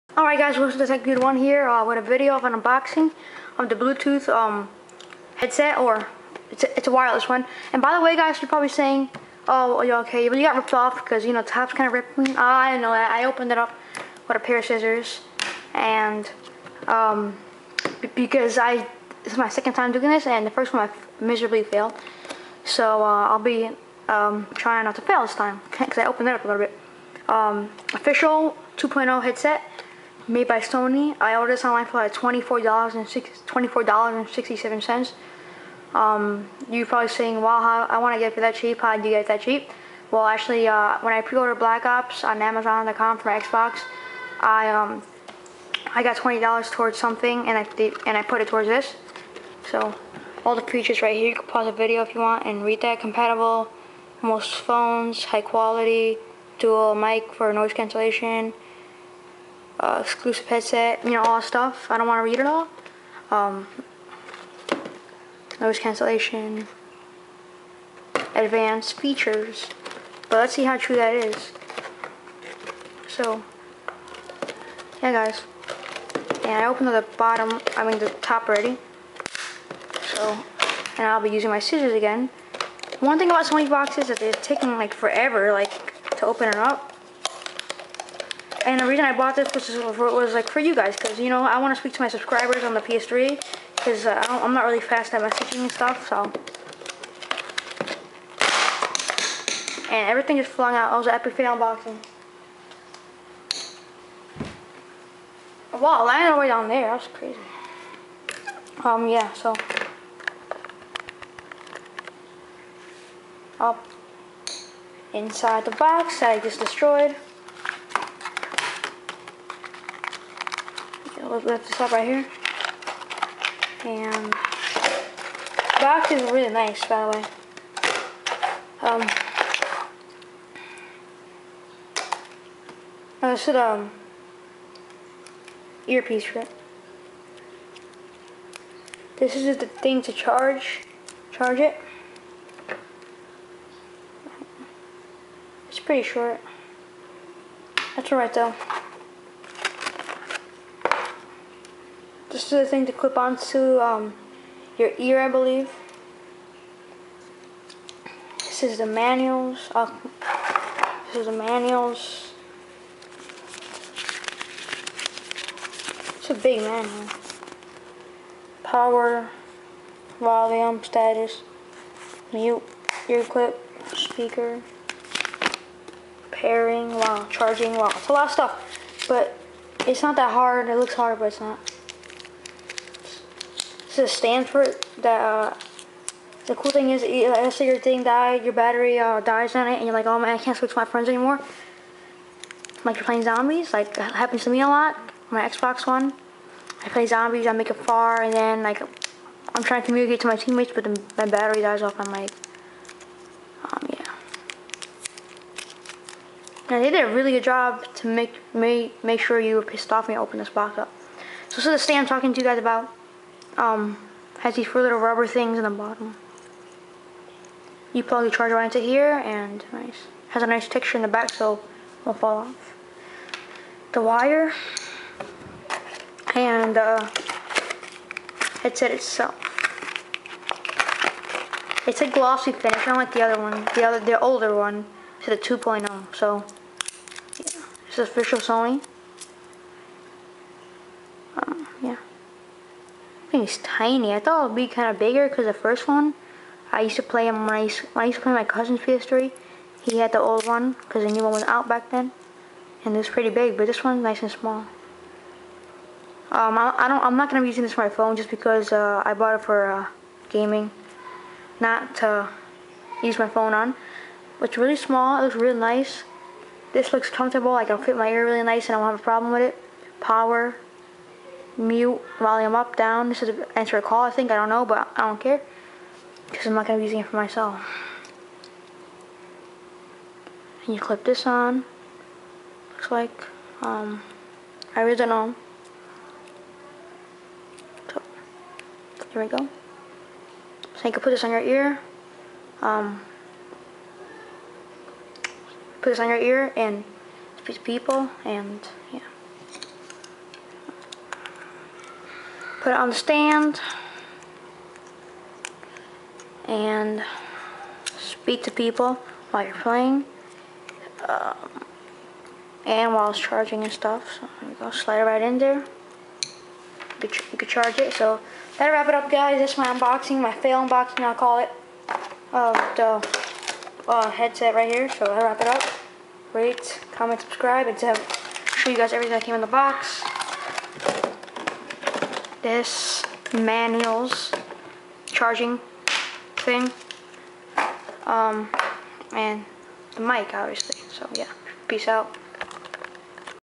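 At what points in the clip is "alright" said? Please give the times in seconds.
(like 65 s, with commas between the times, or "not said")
0 s, 148 s.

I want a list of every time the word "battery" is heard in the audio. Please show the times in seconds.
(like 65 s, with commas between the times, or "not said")
188 s, 201 s.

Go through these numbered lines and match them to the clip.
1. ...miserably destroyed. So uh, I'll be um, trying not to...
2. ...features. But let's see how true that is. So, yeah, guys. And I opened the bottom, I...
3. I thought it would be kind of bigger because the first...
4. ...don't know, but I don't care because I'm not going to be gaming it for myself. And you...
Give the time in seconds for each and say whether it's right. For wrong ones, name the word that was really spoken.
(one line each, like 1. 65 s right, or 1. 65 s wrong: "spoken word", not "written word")
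1. 21 s wrong: "failed", not "destroyed"
2. 68 s right
3. 244 s right
4. 274 s wrong: "using", not "gaming".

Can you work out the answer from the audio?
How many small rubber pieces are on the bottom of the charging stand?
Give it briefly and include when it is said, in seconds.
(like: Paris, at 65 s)
4, at 214 s.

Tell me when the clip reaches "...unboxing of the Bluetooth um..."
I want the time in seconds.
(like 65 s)
2 s.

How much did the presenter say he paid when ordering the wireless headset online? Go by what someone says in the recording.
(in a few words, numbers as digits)
$24.67.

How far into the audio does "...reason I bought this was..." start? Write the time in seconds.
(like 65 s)
88 s.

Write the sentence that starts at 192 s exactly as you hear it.
Like you're playing zombies, like happens to me a lot.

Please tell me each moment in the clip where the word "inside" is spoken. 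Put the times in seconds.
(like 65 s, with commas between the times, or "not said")
115 s.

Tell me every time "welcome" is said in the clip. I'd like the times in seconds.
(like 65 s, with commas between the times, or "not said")
0 s.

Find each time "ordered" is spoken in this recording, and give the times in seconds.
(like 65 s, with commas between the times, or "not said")
31 s, 41 s.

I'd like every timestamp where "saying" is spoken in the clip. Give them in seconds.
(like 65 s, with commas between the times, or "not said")
8 s, 37 s.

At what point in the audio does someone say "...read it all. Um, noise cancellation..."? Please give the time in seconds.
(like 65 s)
62 s.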